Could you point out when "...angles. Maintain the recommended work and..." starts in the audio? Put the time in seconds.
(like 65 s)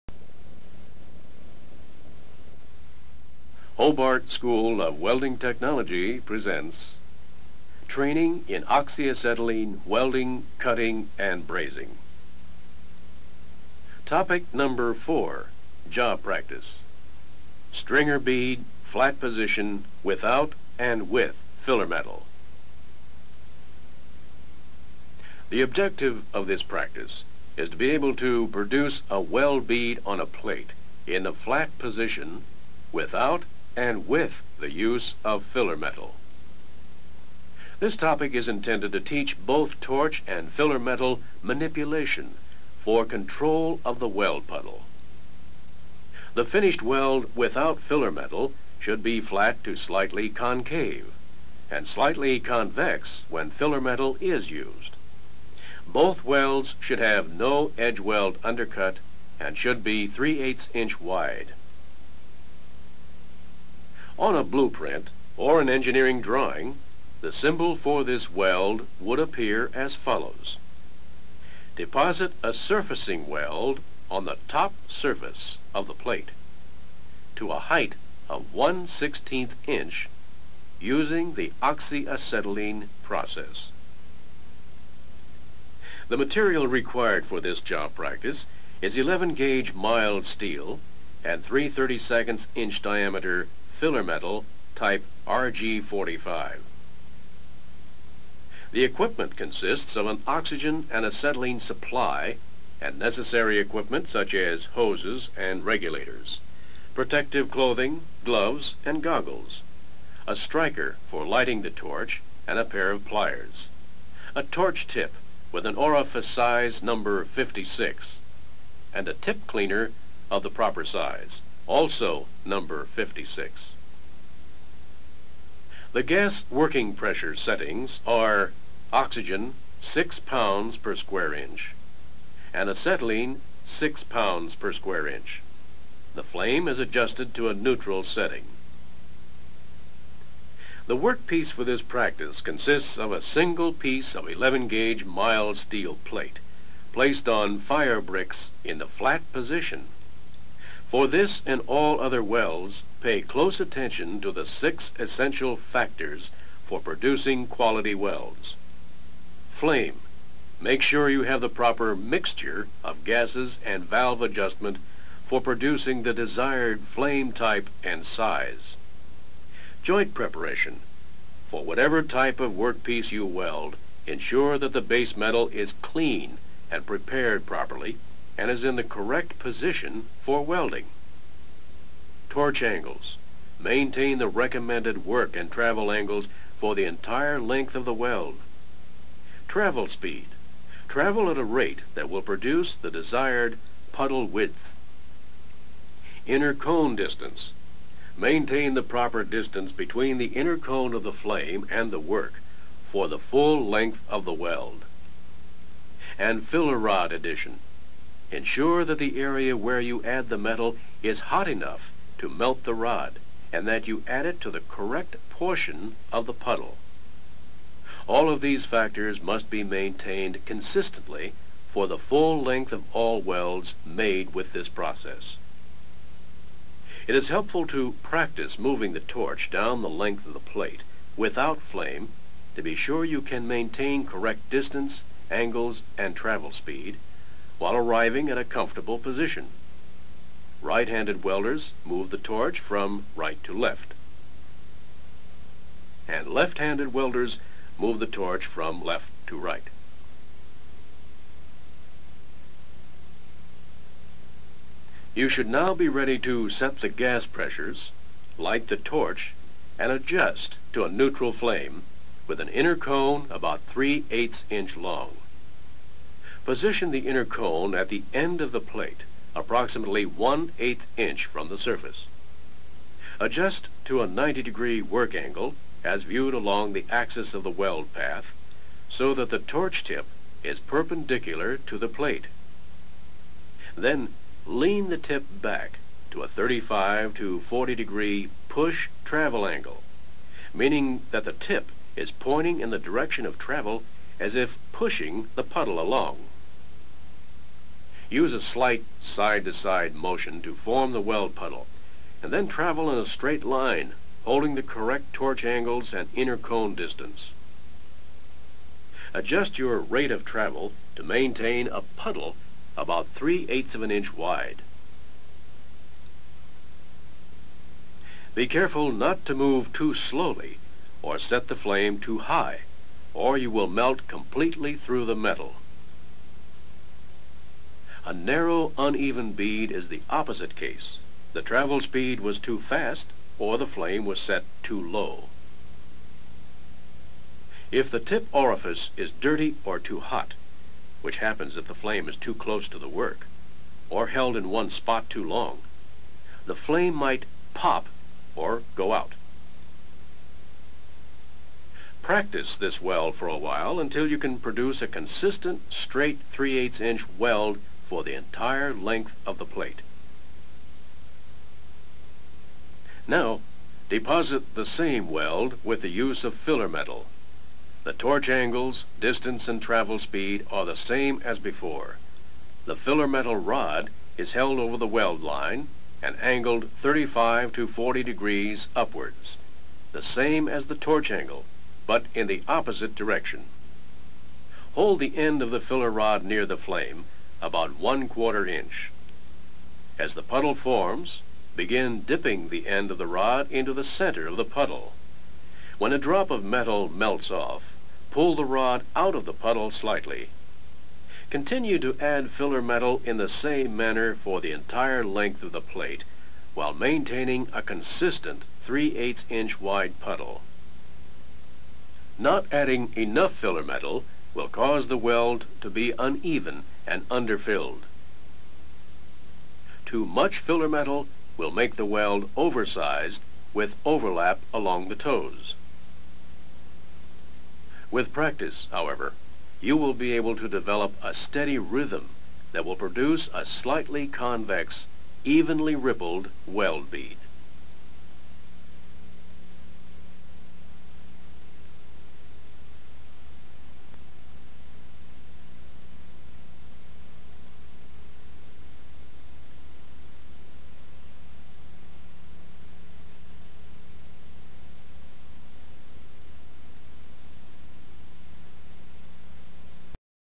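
182 s.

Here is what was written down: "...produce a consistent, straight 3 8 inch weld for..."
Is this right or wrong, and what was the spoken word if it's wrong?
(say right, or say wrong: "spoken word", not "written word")
right.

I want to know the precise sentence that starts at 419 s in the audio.
Too much filler metal will make the weld oversized with overlap along the toes.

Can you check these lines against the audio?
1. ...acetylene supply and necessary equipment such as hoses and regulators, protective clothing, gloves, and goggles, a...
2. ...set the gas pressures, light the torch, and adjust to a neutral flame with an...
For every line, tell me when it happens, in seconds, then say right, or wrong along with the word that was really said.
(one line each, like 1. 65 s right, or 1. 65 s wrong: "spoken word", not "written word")
1. 101 s right
2. 256 s right.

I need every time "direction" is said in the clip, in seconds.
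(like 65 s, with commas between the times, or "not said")
292 s, 382 s.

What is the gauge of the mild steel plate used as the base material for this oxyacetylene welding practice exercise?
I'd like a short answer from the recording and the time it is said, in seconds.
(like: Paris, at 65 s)
11 gauge, at 88 s.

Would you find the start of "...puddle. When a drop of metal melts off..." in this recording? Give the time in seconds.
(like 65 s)
394 s.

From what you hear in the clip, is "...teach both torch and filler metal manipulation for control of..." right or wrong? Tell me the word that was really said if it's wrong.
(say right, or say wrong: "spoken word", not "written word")
right.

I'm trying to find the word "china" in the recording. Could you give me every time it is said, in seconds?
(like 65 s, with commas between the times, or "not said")
not said.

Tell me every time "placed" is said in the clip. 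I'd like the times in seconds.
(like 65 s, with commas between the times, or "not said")
146 s.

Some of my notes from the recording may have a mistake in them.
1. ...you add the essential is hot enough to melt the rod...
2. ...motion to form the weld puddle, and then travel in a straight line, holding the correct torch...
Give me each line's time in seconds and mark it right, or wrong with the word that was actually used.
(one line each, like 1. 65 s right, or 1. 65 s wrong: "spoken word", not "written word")
1. 209 s wrong: "metal", not "essential"
2. 299 s right.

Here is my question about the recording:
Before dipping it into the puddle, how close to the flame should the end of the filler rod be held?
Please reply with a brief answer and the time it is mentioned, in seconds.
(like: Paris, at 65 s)
1/4 inch, at 387 s.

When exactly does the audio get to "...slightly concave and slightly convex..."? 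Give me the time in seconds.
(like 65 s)
49 s.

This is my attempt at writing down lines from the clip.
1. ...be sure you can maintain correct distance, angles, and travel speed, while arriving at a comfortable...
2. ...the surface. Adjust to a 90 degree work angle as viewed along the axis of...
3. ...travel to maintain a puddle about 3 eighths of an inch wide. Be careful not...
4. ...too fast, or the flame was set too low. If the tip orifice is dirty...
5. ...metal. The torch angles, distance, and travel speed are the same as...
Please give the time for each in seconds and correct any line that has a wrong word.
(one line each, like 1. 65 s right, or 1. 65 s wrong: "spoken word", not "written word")
1. 232 s right
2. 271 s right
3. 310 s right
4. 332 s right
5. 366 s right.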